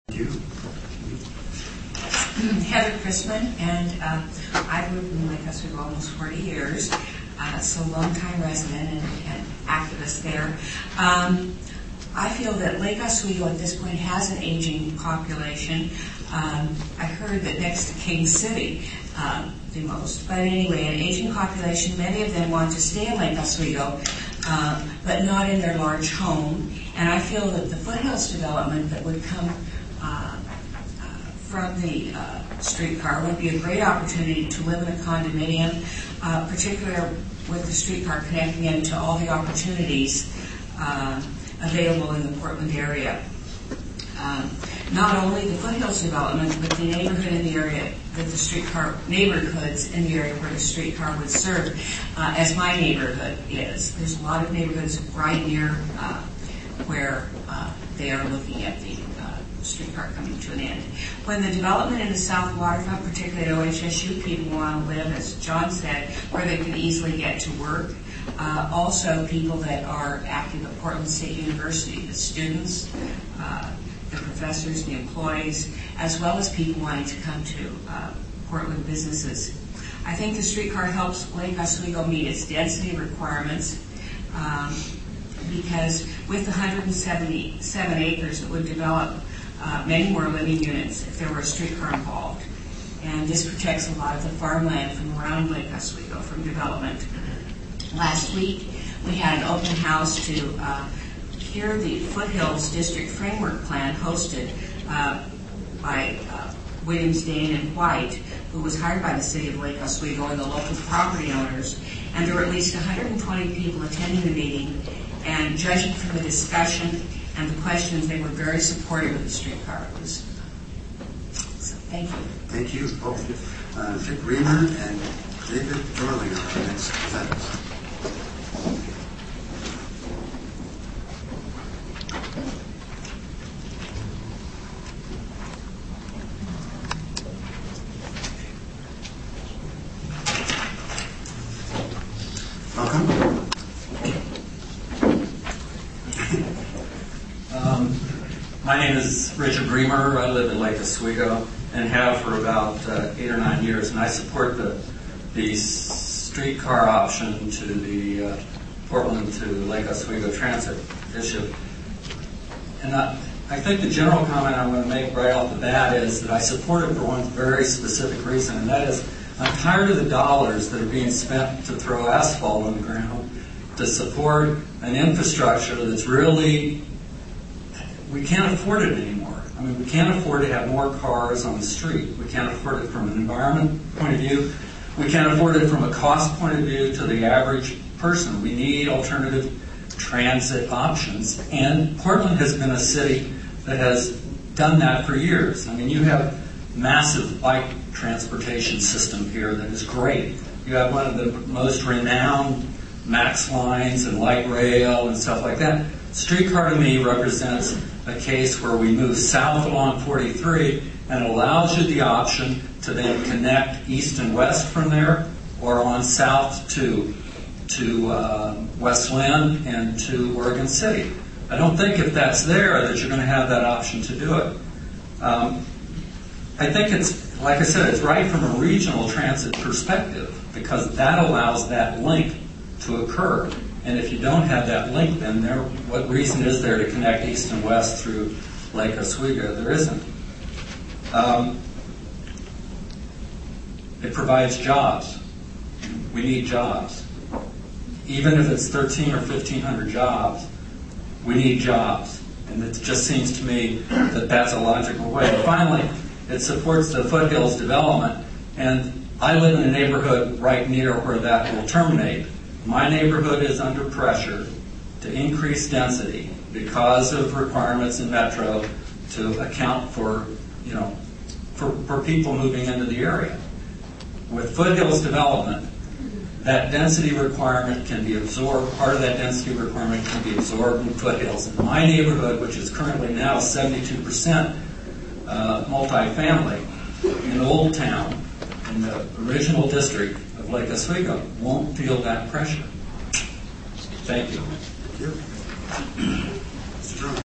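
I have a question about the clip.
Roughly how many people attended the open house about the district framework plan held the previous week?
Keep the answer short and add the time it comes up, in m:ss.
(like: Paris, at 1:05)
120, at 1:52.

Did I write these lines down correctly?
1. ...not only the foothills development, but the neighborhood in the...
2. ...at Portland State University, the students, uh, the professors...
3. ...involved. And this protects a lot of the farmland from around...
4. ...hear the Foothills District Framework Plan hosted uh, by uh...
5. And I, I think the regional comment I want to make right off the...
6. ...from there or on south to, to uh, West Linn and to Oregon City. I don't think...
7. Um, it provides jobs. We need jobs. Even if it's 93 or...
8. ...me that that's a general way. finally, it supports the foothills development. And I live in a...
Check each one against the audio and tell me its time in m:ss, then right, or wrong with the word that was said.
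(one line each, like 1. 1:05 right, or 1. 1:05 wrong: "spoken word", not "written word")
1. 0:44 right
2. 1:10 right
3. 1:31 right
4. 1:41 right
5. 2:42 wrong: "general", not "regional"
6. 3:34 right
7. 4:01 wrong: "13", not "93"
8. 4:13 wrong: "logical", not "general".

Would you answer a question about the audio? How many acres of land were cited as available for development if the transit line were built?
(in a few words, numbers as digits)
177.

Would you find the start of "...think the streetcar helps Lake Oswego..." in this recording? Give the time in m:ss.
1:20.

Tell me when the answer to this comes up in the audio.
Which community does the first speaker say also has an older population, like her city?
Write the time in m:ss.
0:17.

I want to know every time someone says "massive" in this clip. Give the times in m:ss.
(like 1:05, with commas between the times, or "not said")
3:16.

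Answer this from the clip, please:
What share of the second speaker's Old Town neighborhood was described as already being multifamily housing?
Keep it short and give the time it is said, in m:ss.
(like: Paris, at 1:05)
72%, at 4:43.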